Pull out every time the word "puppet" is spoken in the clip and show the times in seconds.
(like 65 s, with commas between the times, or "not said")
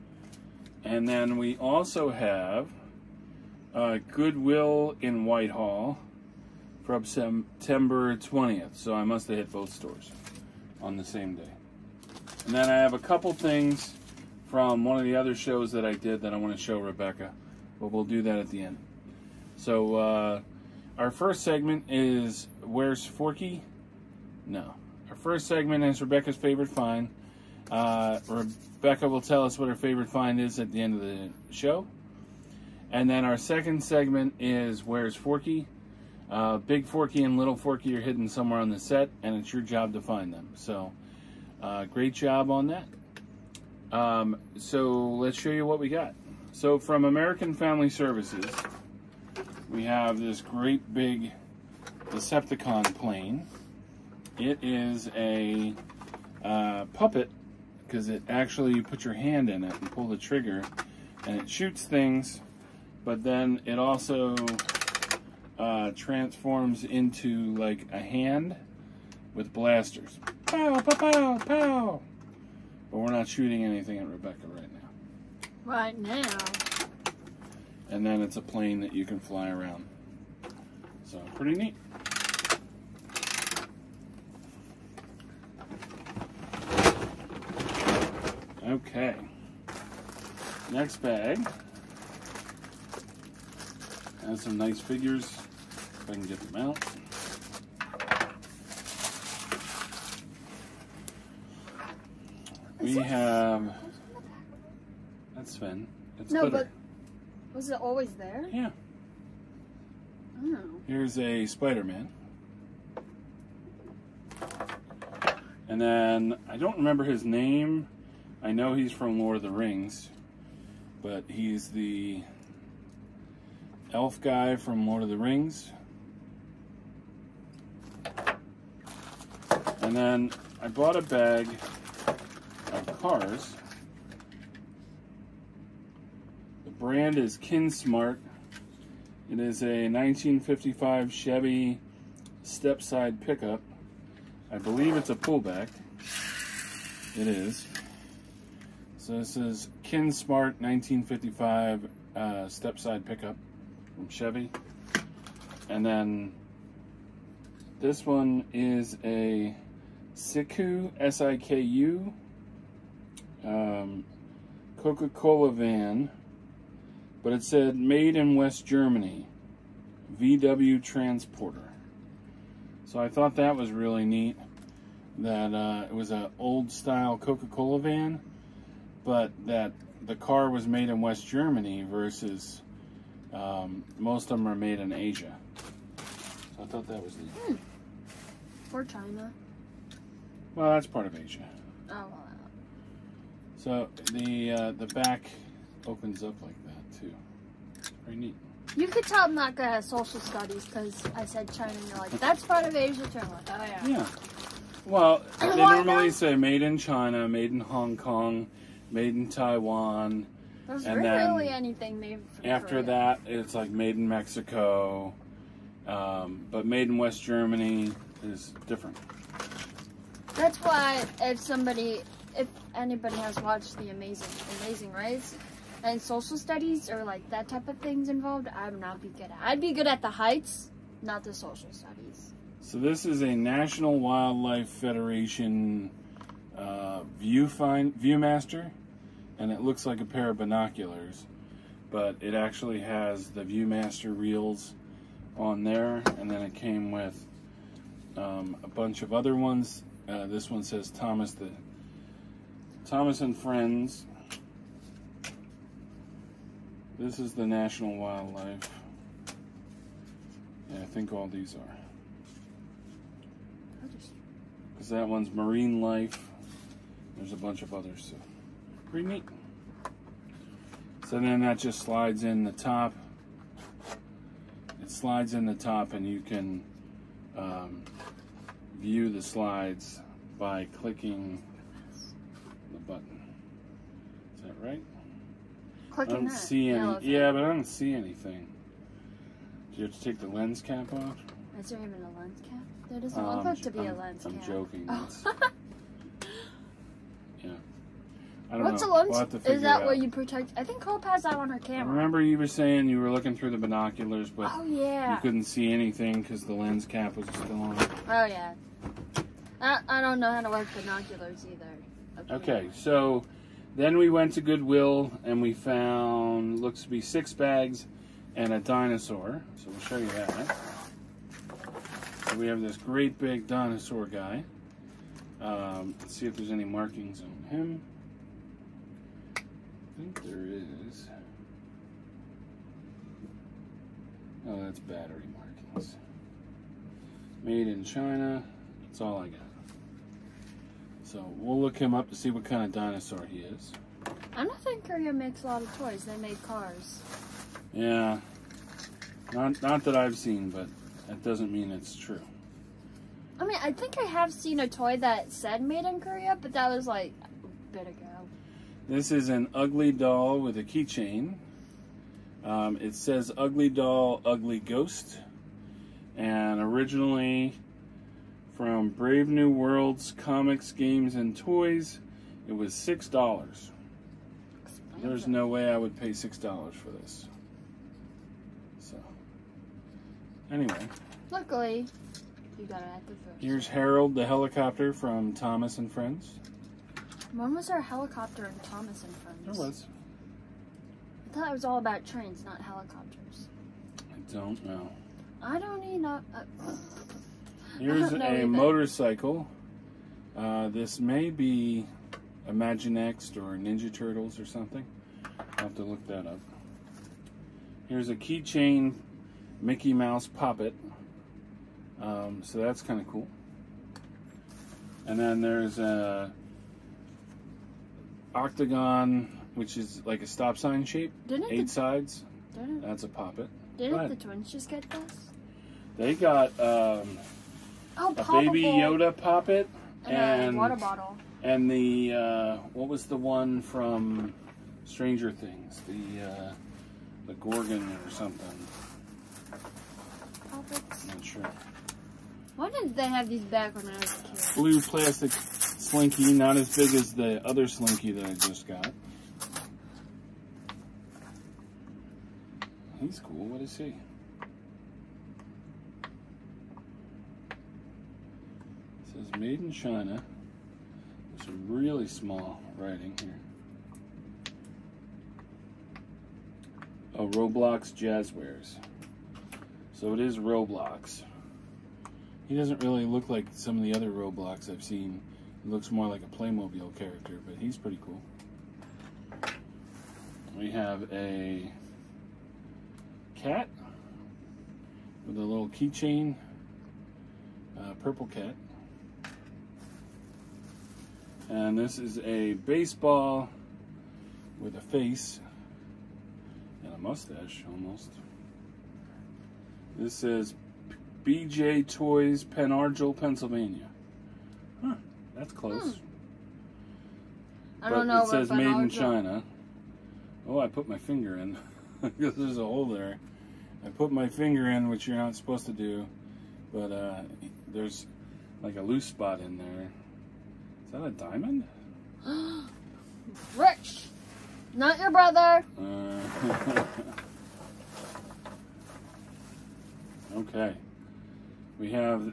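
56 s, 410 s, 423 s, 429 s.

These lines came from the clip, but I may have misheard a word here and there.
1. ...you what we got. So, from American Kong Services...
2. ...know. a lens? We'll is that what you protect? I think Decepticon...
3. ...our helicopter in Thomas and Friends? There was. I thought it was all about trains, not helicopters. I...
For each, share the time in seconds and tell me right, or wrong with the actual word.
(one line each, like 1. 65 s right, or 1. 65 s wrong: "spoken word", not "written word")
1. 45 s wrong: "Family", not "Kong"
2. 298 s wrong: "Hope", not "Decepticon"
3. 387 s right.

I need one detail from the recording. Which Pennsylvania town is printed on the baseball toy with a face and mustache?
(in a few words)
Pen Argyl.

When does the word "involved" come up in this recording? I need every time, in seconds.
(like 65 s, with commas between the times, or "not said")
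228 s.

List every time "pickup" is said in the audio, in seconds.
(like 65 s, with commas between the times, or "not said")
143 s, 153 s.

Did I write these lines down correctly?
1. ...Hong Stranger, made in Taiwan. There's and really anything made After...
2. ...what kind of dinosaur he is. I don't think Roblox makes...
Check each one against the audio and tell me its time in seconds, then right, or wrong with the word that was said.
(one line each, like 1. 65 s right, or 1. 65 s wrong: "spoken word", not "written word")
1. 207 s wrong: "Kong", not "Stranger"
2. 342 s wrong: "Korea", not "Roblox".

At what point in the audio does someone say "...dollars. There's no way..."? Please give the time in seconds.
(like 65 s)
373 s.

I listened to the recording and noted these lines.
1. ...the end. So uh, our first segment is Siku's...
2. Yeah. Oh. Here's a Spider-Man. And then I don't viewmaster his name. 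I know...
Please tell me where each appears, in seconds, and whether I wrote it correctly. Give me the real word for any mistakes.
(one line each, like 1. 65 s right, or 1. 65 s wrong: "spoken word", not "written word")
1. 18 s wrong: "Where", not "Siku"
2. 108 s wrong: "remember", not "viewmaster".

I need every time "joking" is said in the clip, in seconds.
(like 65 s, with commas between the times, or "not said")
294 s.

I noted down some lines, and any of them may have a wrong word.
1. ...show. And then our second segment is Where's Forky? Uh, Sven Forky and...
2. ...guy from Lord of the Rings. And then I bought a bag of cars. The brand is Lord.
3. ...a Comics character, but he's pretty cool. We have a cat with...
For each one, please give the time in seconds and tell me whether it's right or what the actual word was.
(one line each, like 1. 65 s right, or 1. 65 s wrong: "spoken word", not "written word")
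1. 31 s wrong: "Big", not "Sven"
2. 124 s wrong: "Kinsmart", not "Lord"
3. 476 s wrong: "Playmobil", not "Comics".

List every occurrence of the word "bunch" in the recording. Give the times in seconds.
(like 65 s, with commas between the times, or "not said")
248 s, 267 s.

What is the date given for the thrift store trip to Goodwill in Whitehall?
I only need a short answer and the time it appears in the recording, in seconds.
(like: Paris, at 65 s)
September 20th, at 7 s.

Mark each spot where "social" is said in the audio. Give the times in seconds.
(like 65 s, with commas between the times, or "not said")
199 s, 225 s, 231 s.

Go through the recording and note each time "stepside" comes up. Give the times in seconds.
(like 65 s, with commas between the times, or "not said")
142 s, 152 s.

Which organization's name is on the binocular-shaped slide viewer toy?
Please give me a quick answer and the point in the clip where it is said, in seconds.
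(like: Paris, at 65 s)
National Wildlife Federation, at 233 s.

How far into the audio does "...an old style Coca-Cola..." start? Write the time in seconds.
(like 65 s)
176 s.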